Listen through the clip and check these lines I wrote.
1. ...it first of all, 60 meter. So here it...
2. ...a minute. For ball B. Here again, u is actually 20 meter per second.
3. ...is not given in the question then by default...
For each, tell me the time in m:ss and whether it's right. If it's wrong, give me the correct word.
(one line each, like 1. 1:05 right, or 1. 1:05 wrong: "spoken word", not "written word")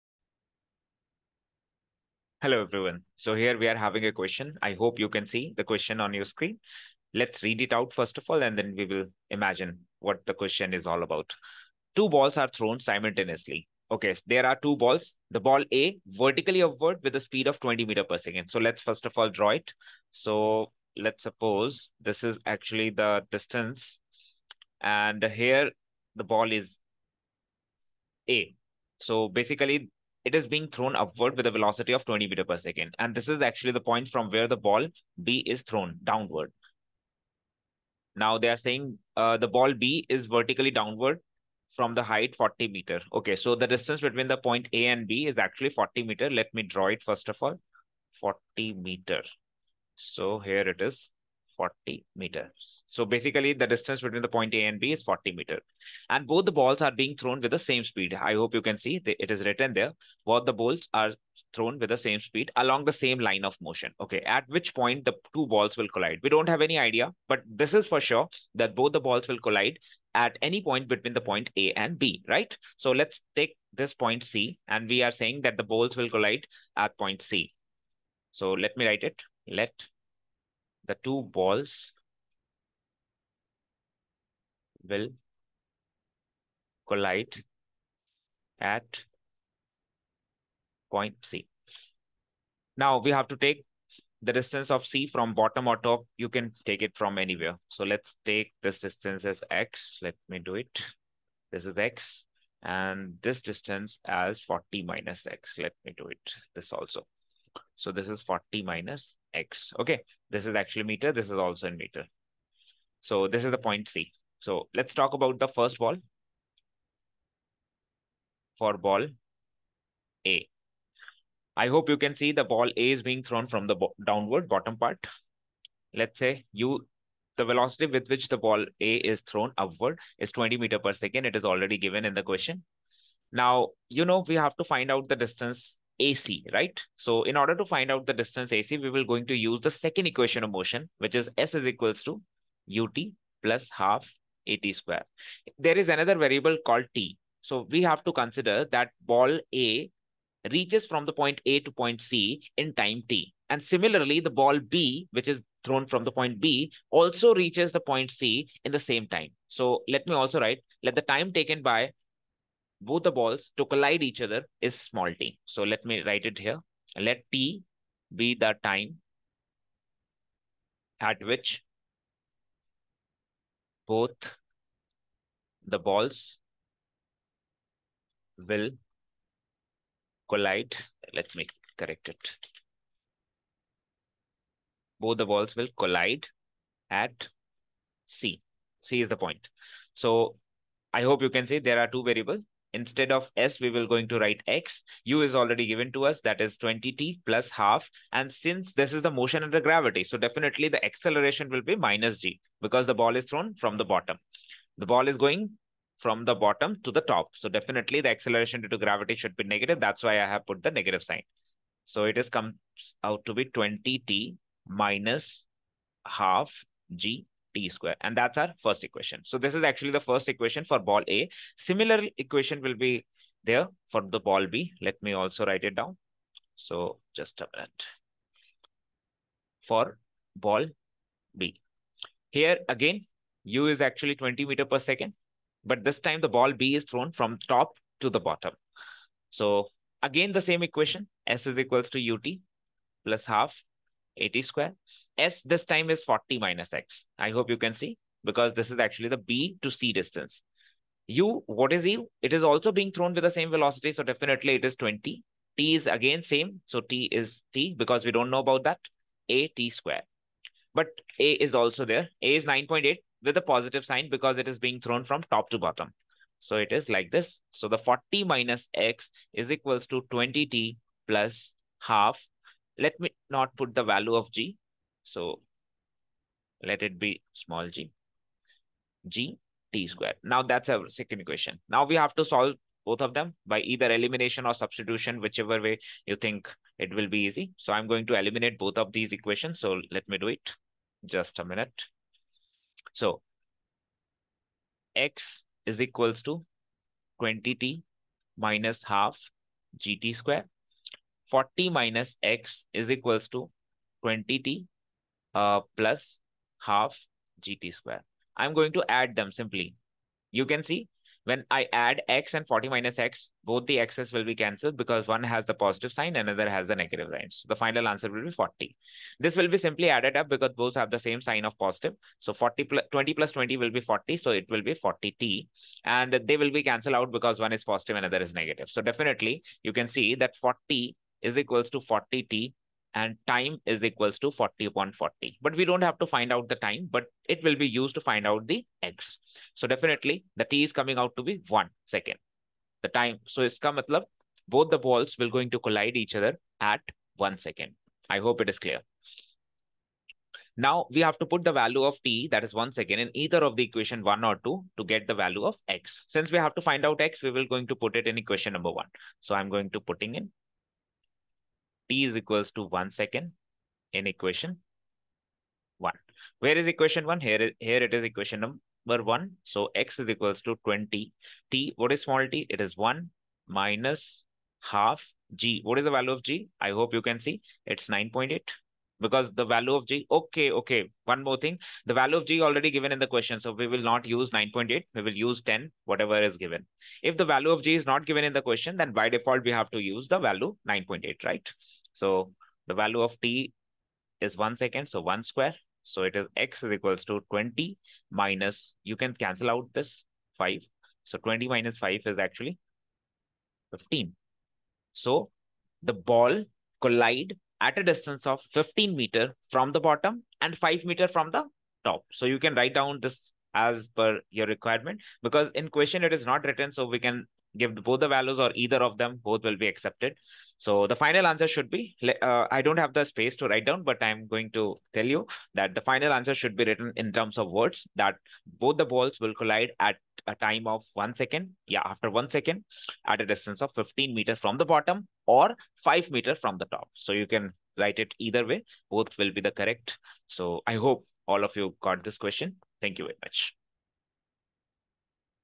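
1. 0:46 wrong: "40", not "60"
2. 3:47 right
3. 6:27 right.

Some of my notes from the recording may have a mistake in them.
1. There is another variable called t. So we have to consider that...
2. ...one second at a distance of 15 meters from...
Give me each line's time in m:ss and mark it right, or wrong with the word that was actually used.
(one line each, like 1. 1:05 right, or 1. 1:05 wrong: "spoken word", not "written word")
1. 2:25 right
2. 7:12 right.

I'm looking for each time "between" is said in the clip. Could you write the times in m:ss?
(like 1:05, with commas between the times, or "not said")
0:44, 0:54, 1:10.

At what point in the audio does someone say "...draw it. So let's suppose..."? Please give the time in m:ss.
0:19.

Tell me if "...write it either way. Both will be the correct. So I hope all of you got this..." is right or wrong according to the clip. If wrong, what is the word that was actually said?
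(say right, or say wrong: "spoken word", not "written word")
right.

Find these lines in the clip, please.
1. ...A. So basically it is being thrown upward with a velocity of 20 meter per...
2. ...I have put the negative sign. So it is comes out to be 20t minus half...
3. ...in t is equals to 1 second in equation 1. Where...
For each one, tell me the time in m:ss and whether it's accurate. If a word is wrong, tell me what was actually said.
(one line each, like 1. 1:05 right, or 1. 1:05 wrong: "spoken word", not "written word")
1. 0:28 right
2. 3:30 right
3. 6:00 right.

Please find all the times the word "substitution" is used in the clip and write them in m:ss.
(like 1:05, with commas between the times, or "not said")
4:44.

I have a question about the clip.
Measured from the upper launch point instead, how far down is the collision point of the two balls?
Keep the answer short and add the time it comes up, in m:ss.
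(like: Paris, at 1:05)
5 meters, at 6:50.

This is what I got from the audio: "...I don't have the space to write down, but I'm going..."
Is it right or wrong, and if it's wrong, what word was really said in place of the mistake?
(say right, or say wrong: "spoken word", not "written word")
right.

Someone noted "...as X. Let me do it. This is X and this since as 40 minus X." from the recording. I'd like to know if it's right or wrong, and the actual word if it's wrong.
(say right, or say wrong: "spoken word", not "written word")
wrong: "distance", not "since".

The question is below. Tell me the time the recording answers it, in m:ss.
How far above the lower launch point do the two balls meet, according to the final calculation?
6:48.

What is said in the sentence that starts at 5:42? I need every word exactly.
The time, so it's come, matlab, both the balls will going to collide each other at 1 second.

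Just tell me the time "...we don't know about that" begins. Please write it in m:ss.
4:18.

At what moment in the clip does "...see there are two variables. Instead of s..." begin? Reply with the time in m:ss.
3:11.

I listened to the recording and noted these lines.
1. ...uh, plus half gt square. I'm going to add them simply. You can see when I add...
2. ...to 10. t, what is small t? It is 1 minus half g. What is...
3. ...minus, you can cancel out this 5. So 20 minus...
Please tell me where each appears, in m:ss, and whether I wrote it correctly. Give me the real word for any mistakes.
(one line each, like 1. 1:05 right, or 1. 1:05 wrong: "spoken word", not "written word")
1. 5:05 right
2. 6:10 wrong: "20", not "10"
3. 6:38 right.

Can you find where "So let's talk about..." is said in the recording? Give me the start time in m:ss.
1:54.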